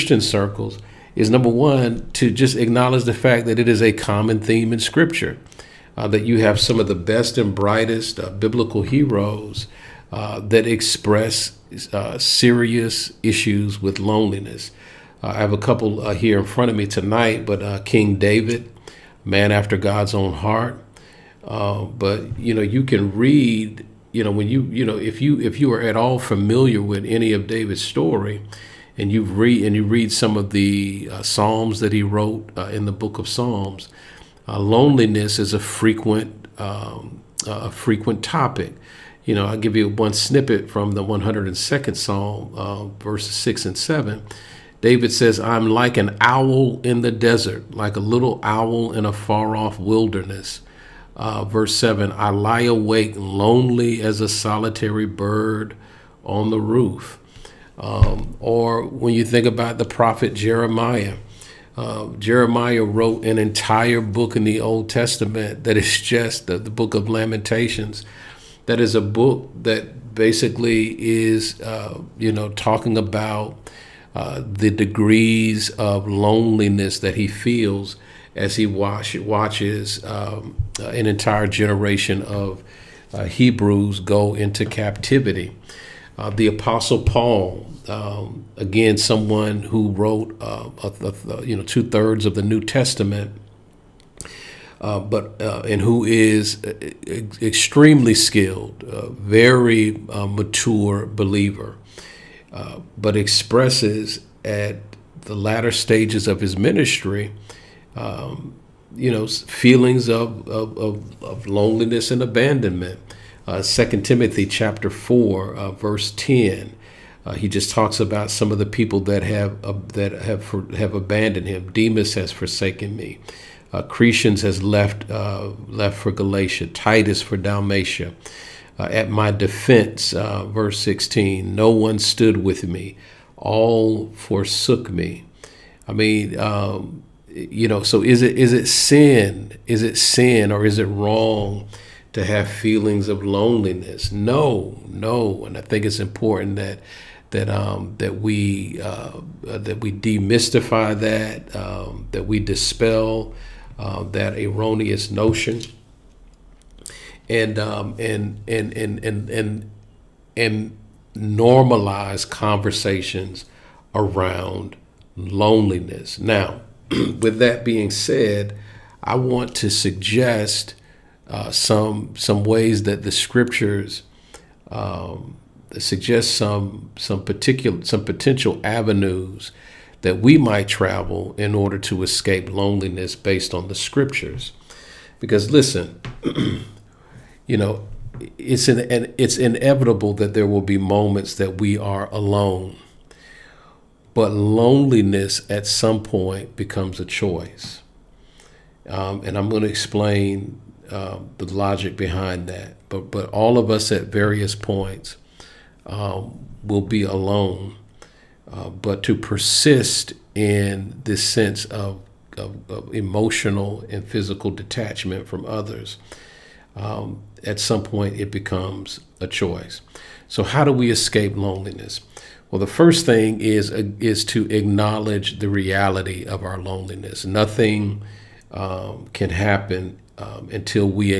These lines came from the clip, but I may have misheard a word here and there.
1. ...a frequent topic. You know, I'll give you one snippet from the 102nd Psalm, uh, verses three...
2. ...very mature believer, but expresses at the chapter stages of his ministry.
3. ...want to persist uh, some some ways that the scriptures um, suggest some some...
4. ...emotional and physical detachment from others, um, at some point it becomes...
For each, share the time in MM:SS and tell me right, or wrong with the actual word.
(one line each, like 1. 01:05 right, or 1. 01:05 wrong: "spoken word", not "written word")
1. 00:37 wrong: "six", not "three"
2. 01:39 wrong: "latter", not "chapter"
3. 02:49 wrong: "suggest", not "persist"
4. 03:32 right.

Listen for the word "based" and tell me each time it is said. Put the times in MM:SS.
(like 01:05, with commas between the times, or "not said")
03:03.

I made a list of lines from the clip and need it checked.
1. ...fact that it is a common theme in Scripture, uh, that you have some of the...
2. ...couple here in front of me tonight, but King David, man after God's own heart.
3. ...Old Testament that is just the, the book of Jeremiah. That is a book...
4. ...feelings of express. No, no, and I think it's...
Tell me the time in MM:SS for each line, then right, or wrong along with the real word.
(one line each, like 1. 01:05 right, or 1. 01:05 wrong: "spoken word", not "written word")
1. 00:03 right
2. 00:15 right
3. 01:04 wrong: "Lamentations", not "Jeremiah"
4. 02:22 wrong: "loneliness", not "express".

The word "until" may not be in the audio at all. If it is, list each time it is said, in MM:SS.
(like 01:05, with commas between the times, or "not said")
03:50.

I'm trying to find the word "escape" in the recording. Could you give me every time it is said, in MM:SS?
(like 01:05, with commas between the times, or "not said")
03:02, 03:40.